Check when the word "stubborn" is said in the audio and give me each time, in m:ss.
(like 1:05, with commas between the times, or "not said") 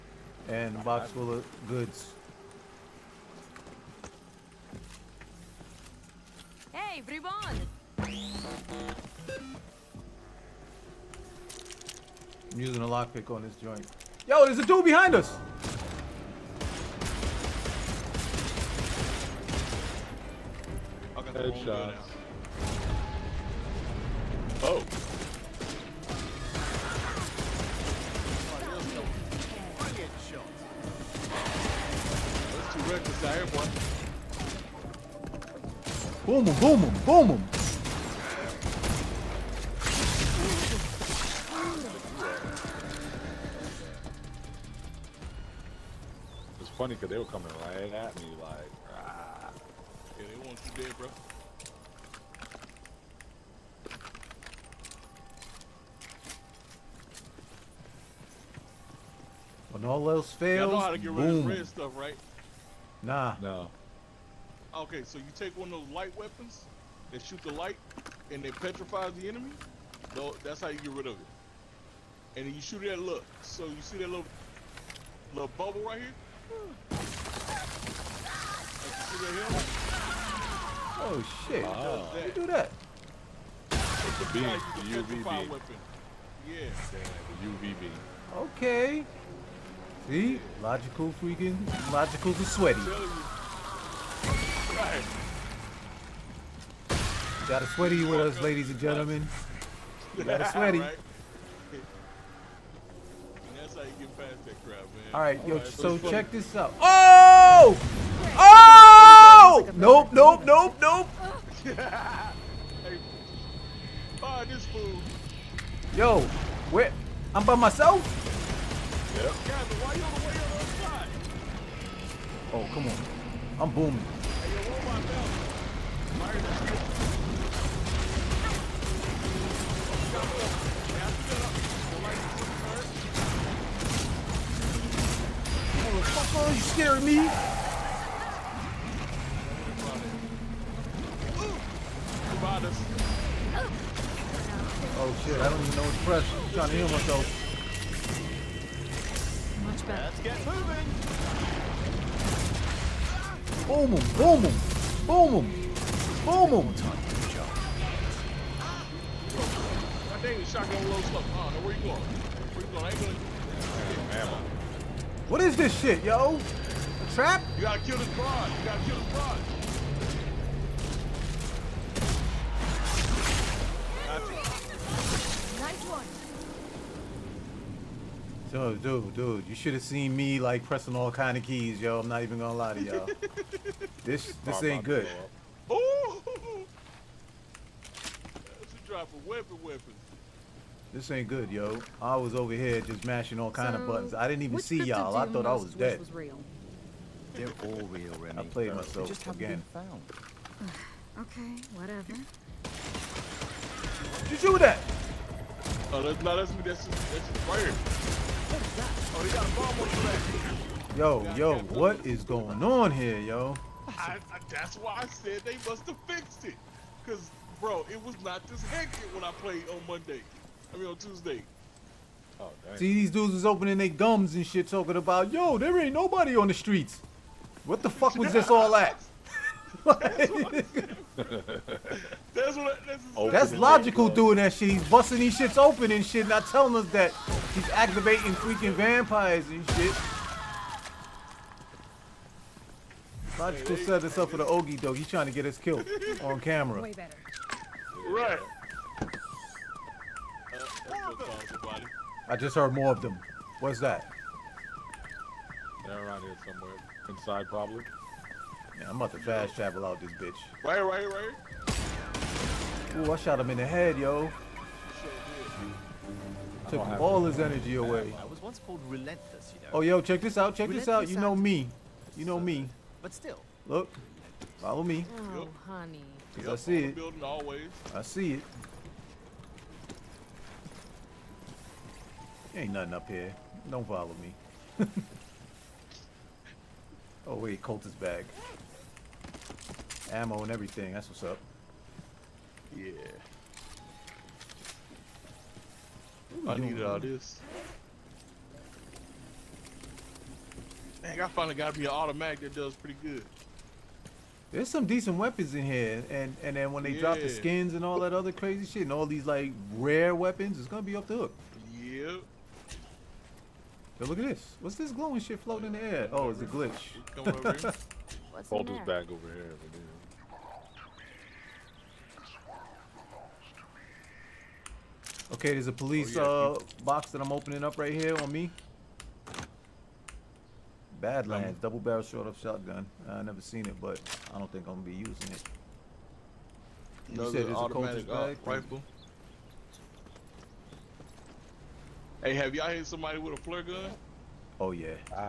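not said.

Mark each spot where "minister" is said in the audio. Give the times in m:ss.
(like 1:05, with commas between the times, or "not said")
not said.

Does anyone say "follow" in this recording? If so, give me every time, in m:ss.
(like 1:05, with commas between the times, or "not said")
4:34, 4:43.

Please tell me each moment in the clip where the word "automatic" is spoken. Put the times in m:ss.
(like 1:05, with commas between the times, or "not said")
5:01, 5:37.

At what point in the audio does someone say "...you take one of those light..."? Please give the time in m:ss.
1:05.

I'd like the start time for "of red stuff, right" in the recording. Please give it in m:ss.
1:01.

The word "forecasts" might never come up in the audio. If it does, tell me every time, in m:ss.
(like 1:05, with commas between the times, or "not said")
not said.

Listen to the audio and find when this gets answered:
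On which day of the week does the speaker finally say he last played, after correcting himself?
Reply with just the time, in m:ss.
3:40.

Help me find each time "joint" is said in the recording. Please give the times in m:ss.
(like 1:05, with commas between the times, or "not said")
0:13.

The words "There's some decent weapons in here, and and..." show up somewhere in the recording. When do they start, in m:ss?
5:04.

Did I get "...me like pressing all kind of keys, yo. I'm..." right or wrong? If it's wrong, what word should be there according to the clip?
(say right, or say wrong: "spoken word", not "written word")
right.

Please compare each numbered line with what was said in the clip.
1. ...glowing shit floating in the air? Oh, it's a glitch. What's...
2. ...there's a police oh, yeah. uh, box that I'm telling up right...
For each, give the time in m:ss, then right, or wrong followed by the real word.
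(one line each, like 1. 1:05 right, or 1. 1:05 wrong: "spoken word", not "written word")
1. 5:14 right
2. 5:25 wrong: "opening", not "telling".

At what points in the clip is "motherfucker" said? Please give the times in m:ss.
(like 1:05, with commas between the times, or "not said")
2:16.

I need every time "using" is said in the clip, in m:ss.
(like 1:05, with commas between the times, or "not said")
0:12, 5:34.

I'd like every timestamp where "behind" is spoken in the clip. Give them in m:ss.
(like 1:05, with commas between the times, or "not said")
0:14.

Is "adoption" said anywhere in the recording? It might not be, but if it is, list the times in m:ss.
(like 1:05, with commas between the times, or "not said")
not said.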